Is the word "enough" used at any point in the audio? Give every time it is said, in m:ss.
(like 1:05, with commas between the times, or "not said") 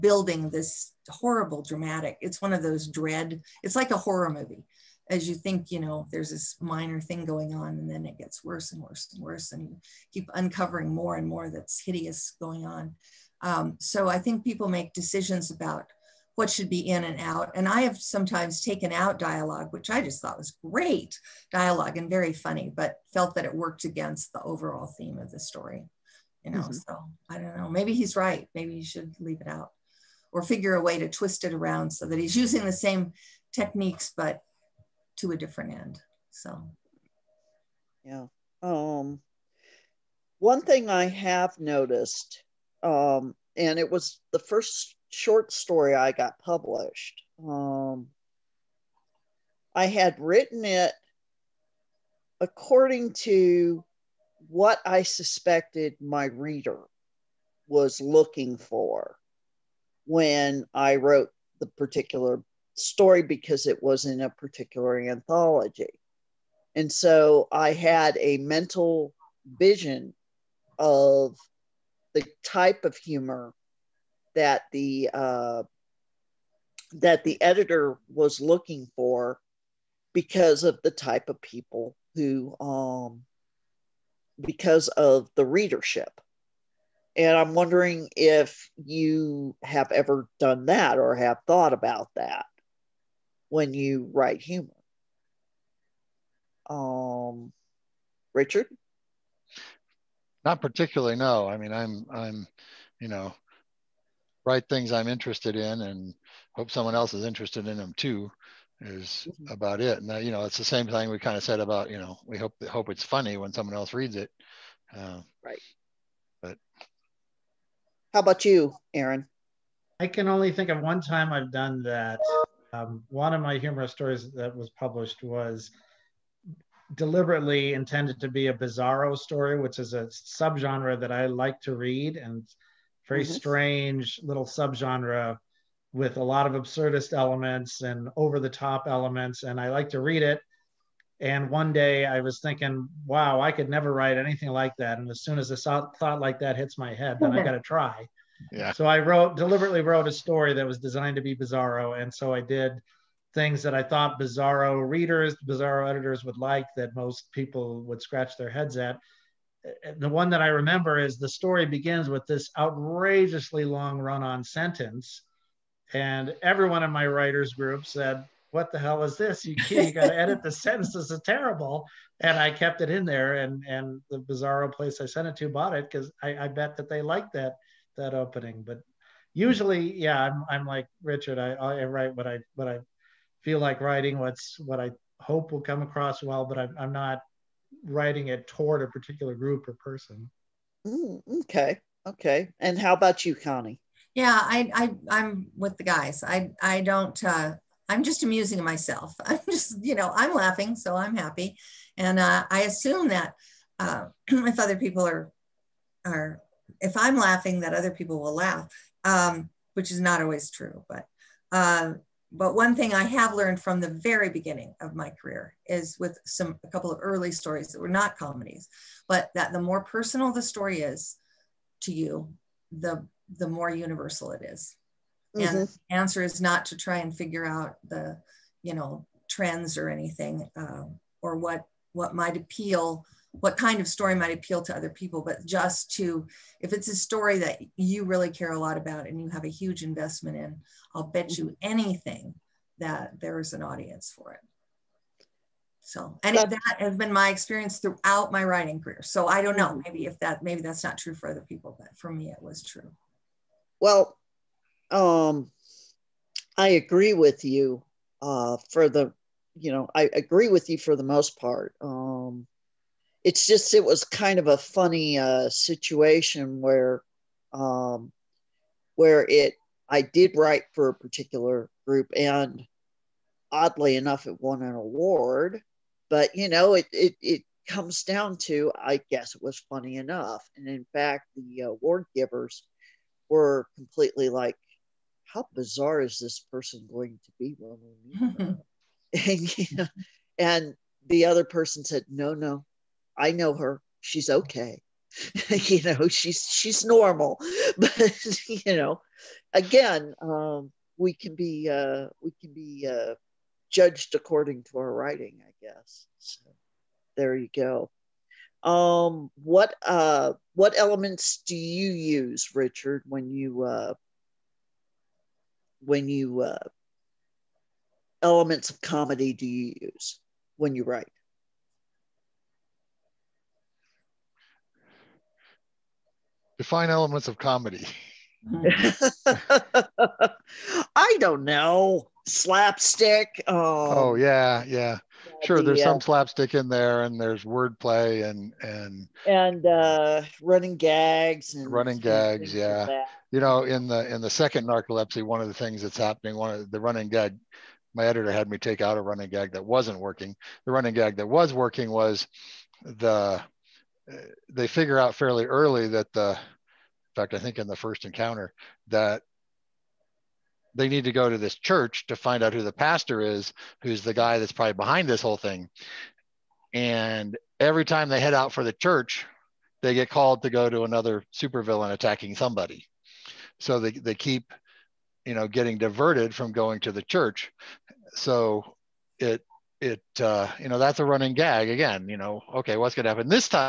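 4:33, 4:39.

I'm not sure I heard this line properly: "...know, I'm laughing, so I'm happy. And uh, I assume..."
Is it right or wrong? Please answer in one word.
right.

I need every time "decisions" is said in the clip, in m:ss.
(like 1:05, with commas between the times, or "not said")
0:14.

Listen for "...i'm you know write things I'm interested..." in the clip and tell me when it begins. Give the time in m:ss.
1:42.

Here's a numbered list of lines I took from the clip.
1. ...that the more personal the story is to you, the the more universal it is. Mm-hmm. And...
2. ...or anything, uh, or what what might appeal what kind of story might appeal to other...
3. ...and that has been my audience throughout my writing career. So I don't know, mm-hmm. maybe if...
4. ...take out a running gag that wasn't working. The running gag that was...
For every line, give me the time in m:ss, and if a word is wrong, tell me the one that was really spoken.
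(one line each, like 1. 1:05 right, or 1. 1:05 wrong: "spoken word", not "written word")
1. 3:39 right
2. 3:49 right
3. 4:06 wrong: "experience", not "audience"
4. 5:48 right.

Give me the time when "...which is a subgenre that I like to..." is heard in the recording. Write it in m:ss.
2:09.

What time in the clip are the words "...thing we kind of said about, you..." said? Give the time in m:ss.
1:50.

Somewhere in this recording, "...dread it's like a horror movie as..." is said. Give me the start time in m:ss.
0:02.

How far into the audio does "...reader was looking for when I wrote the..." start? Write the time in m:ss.
0:56.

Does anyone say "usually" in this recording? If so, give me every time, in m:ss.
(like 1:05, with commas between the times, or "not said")
2:59.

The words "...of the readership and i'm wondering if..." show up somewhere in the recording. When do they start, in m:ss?
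1:24.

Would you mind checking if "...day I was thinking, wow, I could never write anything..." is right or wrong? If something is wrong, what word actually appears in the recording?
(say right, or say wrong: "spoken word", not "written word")
right.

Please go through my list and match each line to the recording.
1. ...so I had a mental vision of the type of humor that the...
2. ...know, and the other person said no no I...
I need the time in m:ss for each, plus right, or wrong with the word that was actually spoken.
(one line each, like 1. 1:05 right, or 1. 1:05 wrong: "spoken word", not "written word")
1. 1:06 right
2. 4:49 right.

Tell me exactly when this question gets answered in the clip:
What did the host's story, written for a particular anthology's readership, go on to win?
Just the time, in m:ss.
4:34.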